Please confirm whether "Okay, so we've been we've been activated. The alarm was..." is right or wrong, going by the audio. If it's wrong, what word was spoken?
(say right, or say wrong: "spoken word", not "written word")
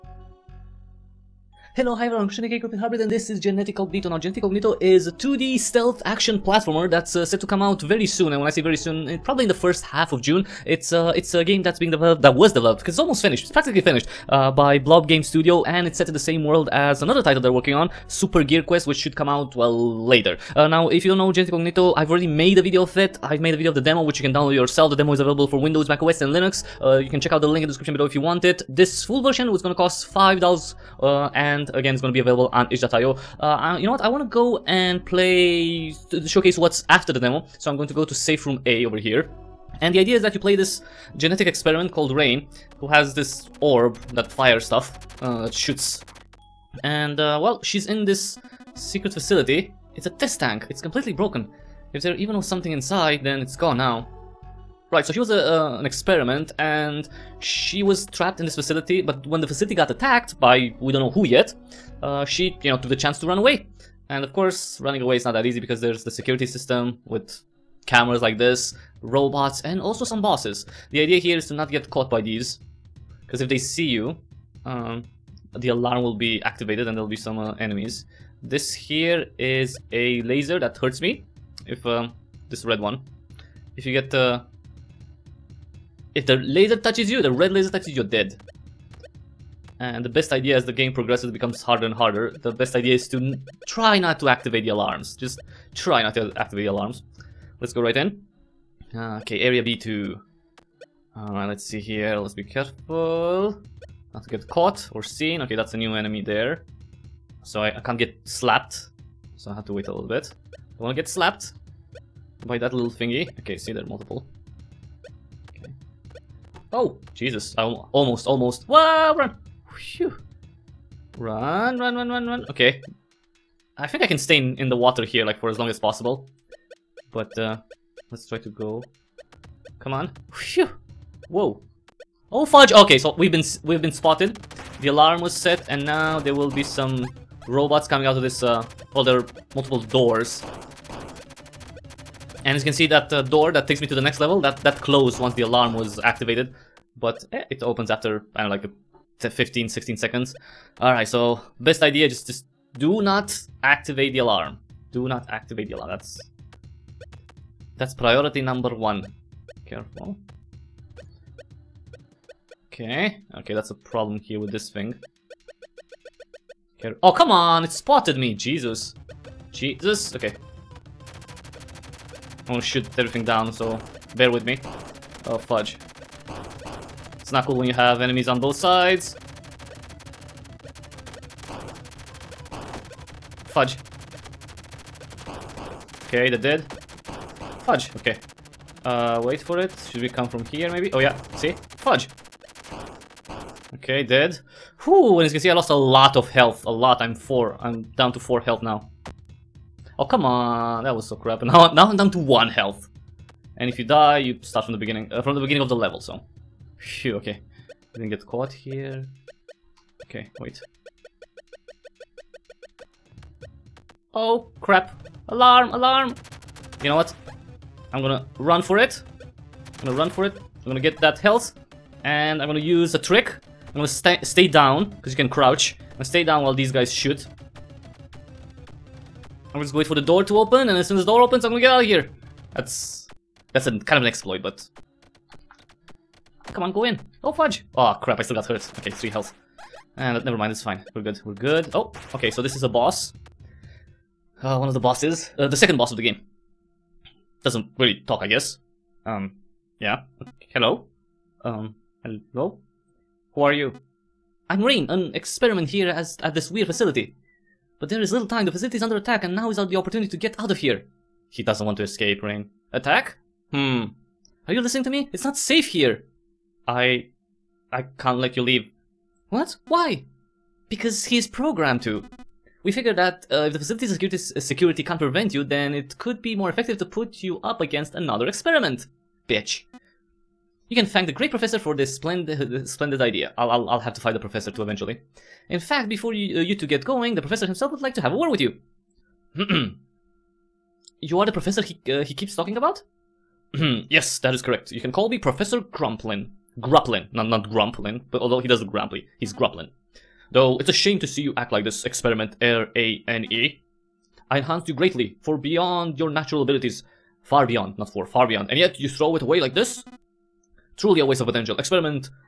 wrong: "spotted", not "activated".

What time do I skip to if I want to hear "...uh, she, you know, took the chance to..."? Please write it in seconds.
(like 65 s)
62 s.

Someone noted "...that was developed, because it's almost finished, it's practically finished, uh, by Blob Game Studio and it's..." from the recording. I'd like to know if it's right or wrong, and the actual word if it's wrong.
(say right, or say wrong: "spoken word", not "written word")
right.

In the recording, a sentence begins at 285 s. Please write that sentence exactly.
In fact, before you, uh, you two get going, the professor himself would like to have a word with you.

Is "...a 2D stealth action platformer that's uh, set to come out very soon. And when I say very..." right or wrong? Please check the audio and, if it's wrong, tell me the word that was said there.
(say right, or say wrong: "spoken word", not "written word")
right.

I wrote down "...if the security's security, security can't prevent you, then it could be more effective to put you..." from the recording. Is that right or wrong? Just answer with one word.
wrong.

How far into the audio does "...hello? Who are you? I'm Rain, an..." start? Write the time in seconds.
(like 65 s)
252 s.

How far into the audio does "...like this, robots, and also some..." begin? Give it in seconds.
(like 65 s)
68 s.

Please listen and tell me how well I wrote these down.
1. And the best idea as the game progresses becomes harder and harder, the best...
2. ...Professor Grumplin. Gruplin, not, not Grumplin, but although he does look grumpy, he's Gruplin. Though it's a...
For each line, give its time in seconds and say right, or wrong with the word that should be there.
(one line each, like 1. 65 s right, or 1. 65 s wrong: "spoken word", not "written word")
1. 89 s right
2. 295 s right.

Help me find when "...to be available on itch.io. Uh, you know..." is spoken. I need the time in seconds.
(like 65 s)
32 s.